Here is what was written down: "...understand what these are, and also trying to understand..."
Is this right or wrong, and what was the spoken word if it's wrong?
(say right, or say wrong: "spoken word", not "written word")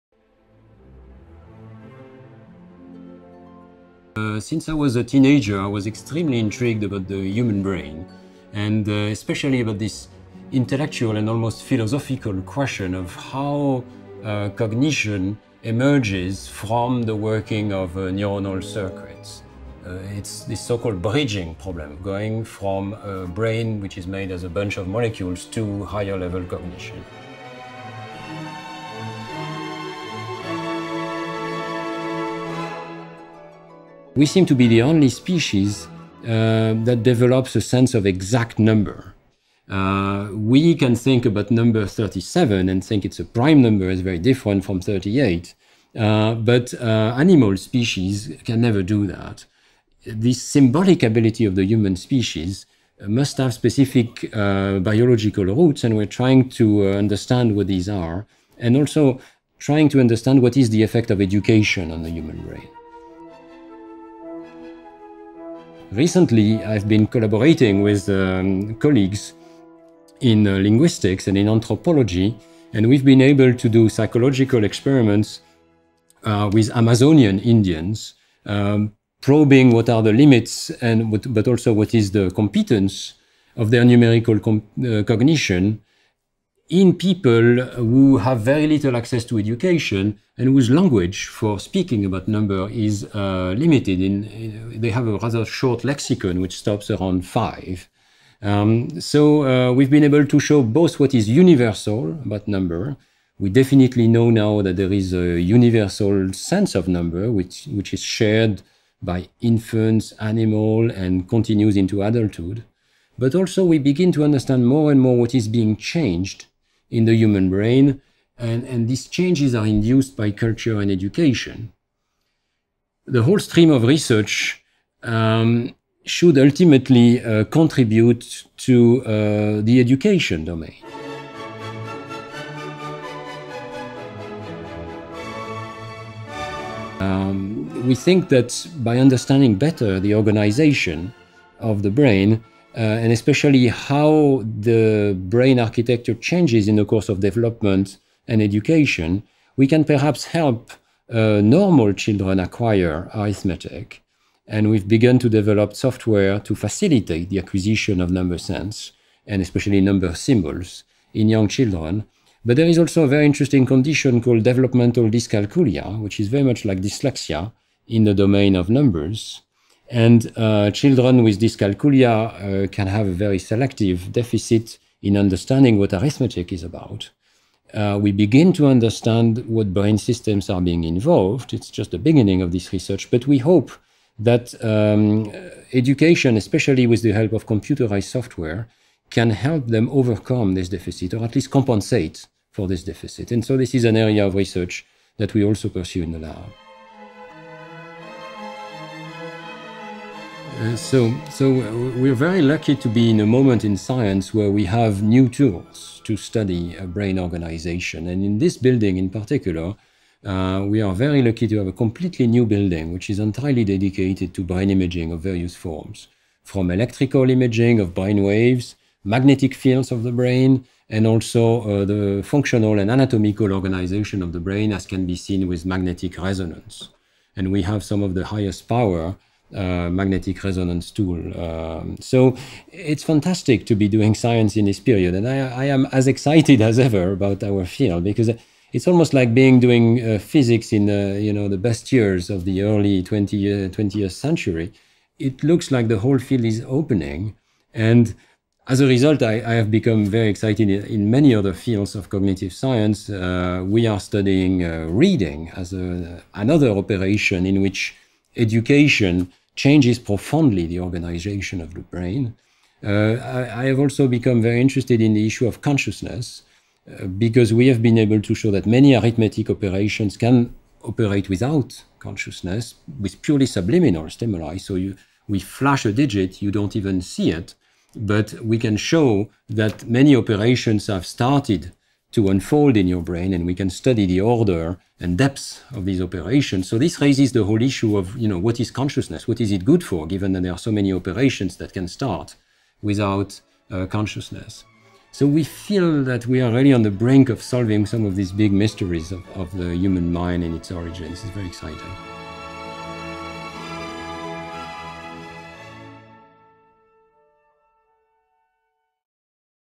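right.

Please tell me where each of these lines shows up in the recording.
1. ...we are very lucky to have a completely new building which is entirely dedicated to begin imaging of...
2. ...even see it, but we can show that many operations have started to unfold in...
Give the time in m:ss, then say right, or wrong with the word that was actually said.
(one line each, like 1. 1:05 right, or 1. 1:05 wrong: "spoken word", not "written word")
1. 3:30 wrong: "brain", not "begin"
2. 4:36 right.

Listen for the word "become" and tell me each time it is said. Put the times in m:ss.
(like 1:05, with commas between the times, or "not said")
4:09, 4:24.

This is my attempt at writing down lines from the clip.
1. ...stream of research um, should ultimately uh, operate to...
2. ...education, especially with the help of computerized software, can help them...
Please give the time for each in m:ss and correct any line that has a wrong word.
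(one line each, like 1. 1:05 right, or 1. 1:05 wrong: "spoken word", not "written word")
1. 2:03 wrong: "contribute", not "operate"
2. 3:05 right.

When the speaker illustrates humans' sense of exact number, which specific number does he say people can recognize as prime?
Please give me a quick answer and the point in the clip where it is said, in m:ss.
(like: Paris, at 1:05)
37, at 0:41.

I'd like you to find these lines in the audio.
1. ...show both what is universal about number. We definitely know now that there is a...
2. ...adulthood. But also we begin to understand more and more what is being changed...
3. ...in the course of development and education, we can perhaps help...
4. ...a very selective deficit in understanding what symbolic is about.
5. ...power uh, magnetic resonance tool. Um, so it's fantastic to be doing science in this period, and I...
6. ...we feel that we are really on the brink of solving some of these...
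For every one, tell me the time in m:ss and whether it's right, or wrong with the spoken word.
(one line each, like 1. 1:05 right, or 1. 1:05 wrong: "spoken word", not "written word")
1. 1:40 right
2. 1:52 right
3. 2:26 right
4. 2:53 wrong: "arithmetic", not "symbolic"
5. 3:48 right
6. 4:55 right.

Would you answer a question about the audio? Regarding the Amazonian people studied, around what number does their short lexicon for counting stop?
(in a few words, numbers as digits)
5.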